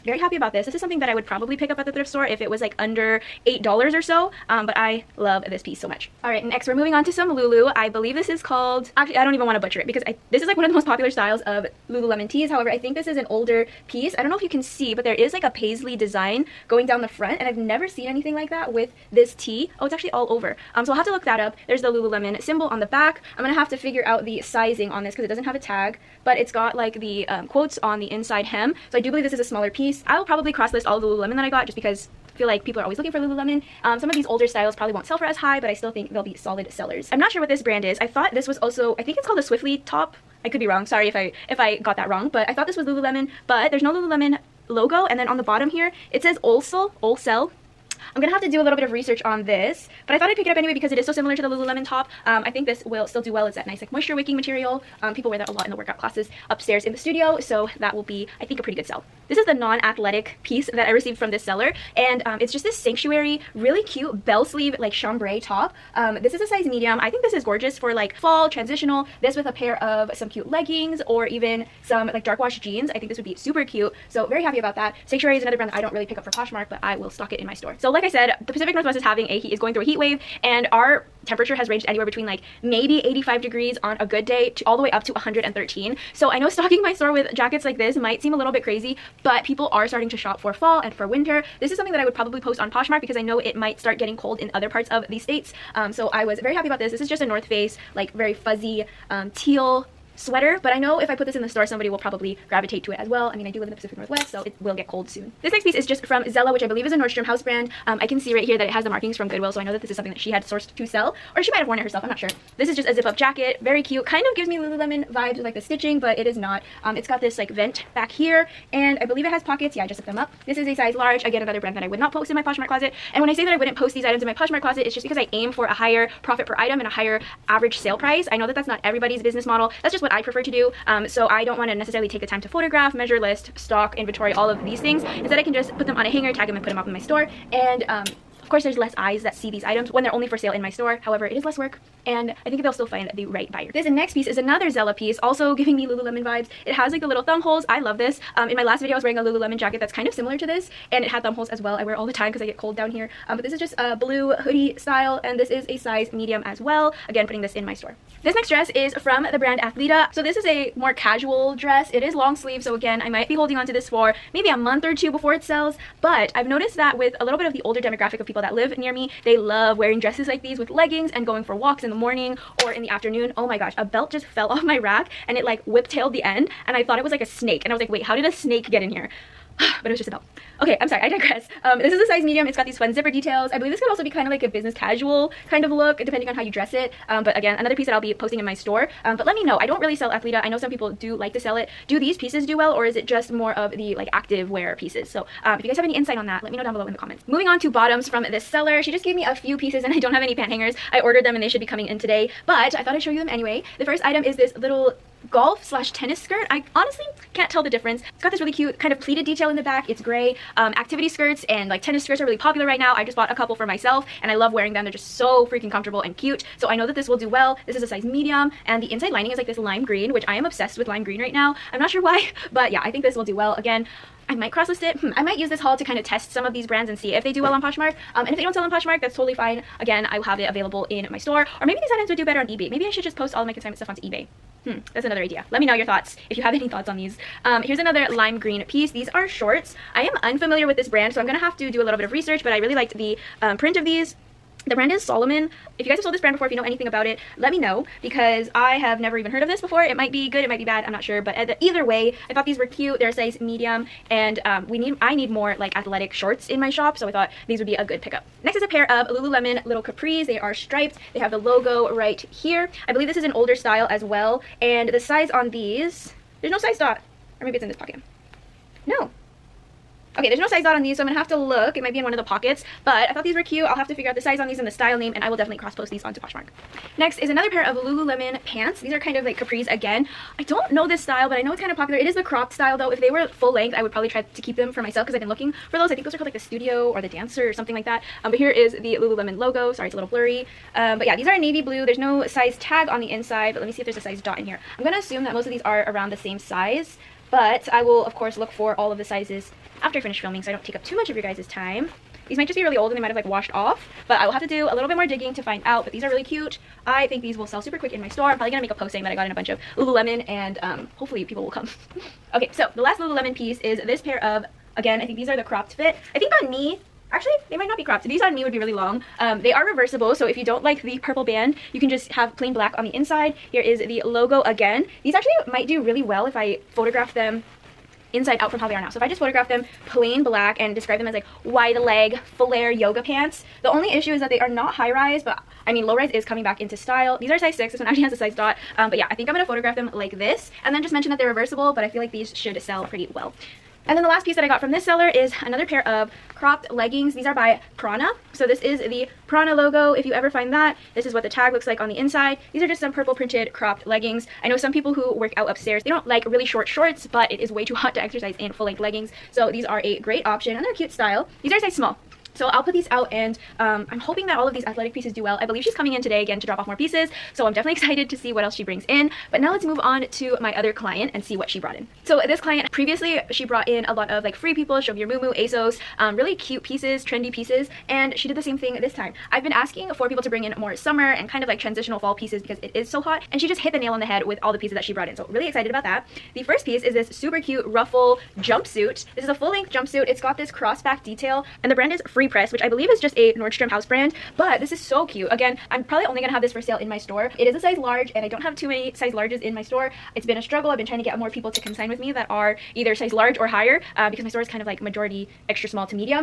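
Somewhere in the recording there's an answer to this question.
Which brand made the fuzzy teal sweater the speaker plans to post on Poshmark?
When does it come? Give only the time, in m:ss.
1:37.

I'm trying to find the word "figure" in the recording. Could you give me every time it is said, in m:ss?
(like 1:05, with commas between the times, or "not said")
0:23, 4:33.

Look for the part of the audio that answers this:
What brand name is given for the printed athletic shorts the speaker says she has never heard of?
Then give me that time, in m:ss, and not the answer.
4:05.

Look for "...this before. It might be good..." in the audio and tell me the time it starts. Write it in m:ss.
4:09.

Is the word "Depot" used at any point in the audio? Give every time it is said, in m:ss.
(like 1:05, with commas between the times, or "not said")
not said.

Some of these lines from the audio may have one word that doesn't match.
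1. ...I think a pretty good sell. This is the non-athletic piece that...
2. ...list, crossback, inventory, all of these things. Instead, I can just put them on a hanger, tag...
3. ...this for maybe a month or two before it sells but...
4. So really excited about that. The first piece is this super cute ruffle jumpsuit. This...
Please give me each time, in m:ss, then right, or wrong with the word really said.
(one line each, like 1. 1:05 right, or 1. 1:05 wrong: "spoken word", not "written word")
1. 0:58 right
2. 2:13 wrong: "stock", not "crossback"
3. 2:43 right
4. 6:25 right.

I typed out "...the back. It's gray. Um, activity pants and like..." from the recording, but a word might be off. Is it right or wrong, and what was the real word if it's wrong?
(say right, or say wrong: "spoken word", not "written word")
wrong: "skirts", not "pants".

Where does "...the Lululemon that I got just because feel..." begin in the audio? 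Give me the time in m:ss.
0:31.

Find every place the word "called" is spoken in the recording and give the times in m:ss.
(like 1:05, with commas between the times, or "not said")
0:08, 0:39, 4:46.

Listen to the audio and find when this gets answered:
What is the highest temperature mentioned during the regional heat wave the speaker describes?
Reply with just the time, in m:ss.
1:25.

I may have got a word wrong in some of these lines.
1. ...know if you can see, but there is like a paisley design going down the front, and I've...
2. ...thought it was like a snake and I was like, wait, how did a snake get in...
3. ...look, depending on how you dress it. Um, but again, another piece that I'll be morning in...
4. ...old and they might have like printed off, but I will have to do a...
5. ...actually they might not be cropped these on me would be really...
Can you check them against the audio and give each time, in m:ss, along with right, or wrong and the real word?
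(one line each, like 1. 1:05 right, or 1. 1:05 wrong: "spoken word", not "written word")
1. 0:14 right
2. 2:56 right
3. 3:05 wrong: "posting", not "morning"
4. 5:02 wrong: "washed", not "printed"
5. 5:17 right.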